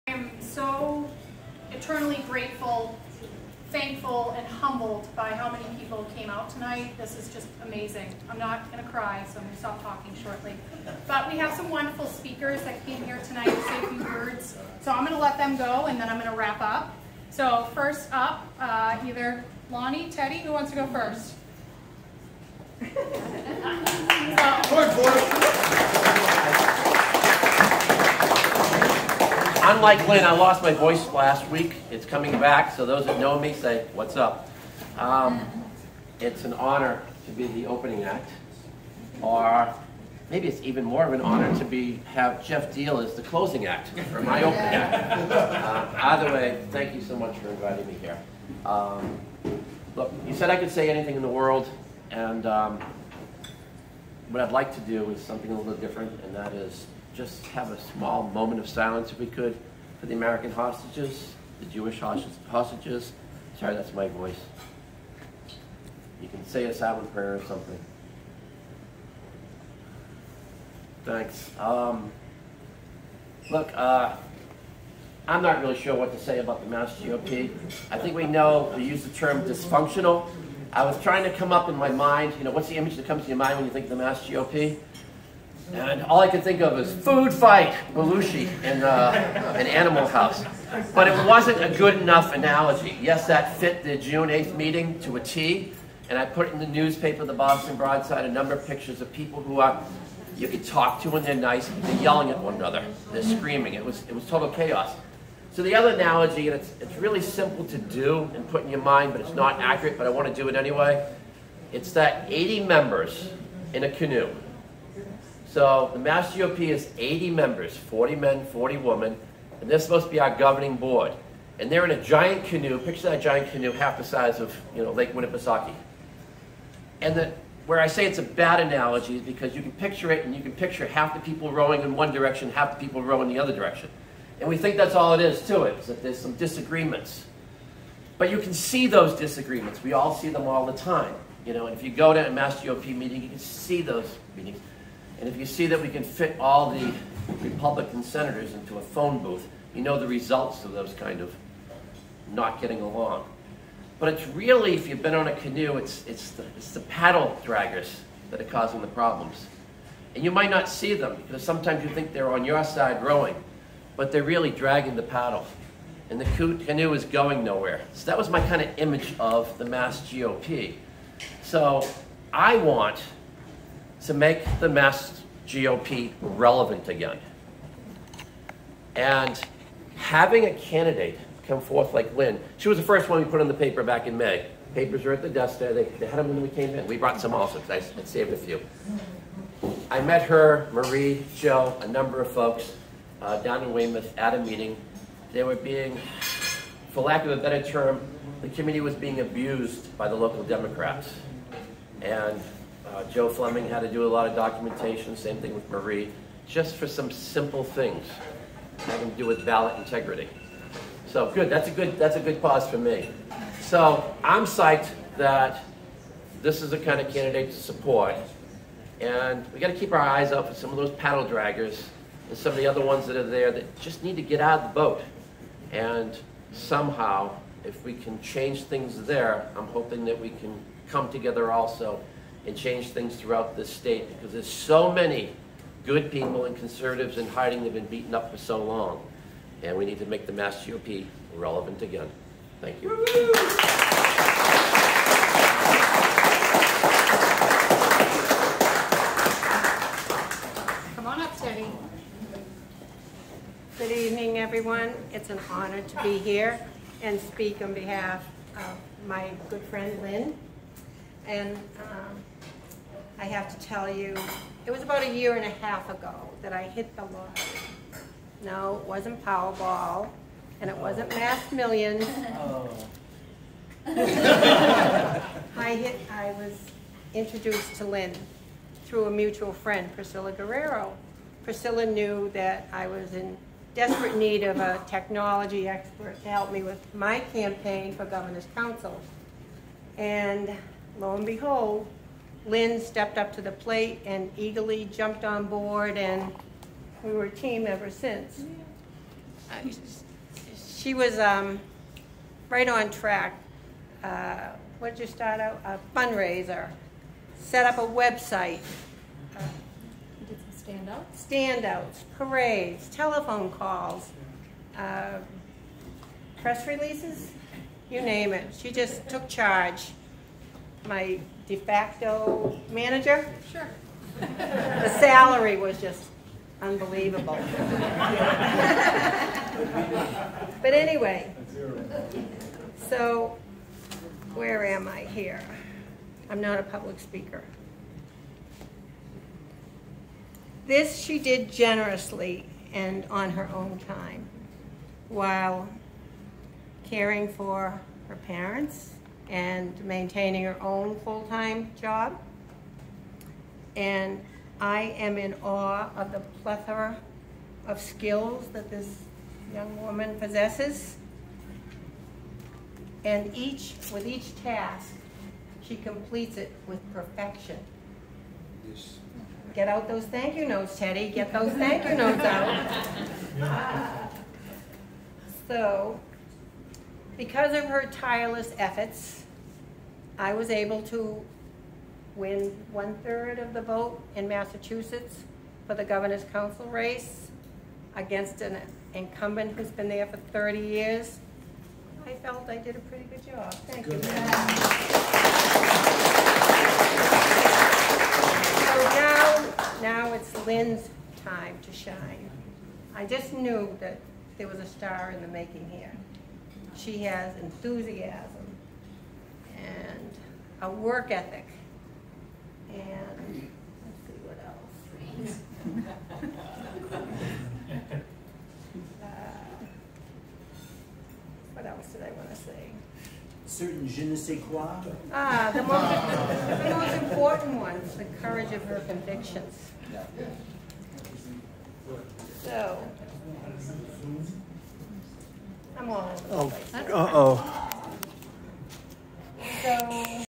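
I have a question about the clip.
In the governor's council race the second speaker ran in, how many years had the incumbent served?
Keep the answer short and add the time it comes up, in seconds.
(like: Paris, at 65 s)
30, at 390 s.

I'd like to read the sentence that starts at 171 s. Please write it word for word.
So I want to make the Mass GOP relevant again.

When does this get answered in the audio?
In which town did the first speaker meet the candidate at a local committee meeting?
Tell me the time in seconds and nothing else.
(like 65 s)
193 s.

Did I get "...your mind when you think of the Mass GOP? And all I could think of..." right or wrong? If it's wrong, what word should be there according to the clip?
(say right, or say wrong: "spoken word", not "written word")
right.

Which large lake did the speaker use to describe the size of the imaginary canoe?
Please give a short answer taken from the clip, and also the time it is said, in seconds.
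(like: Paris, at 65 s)
Lake Winnipesaukee, at 124 s.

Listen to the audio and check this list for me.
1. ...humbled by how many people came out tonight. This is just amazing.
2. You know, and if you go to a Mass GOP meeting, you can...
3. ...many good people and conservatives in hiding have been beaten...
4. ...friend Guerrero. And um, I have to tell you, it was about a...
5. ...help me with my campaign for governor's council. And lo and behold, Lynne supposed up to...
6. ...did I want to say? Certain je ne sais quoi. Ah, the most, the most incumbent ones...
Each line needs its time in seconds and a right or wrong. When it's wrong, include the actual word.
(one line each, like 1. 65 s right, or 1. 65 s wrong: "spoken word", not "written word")
1. 4 s right
2. 141 s right
3. 234 s right
4. 259 s wrong: "Lynne", not "Guerrero"
5. 286 s wrong: "stepped", not "supposed"
6. 421 s wrong: "important", not "incumbent".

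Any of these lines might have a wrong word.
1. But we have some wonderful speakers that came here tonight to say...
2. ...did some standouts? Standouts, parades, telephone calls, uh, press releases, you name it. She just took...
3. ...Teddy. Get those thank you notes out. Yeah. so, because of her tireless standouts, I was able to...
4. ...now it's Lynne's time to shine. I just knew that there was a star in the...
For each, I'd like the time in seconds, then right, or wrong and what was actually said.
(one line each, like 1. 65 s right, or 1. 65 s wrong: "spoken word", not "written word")
1. 11 s right
2. 310 s right
3. 370 s wrong: "efforts", not "standouts"
4. 399 s right.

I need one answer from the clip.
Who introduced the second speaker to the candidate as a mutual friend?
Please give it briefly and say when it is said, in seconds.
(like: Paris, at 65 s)
Priscilla Guerrero, at 279 s.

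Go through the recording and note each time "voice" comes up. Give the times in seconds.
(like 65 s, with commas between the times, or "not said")
30 s, 64 s.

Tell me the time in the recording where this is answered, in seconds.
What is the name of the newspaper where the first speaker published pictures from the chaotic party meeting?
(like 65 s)
97 s.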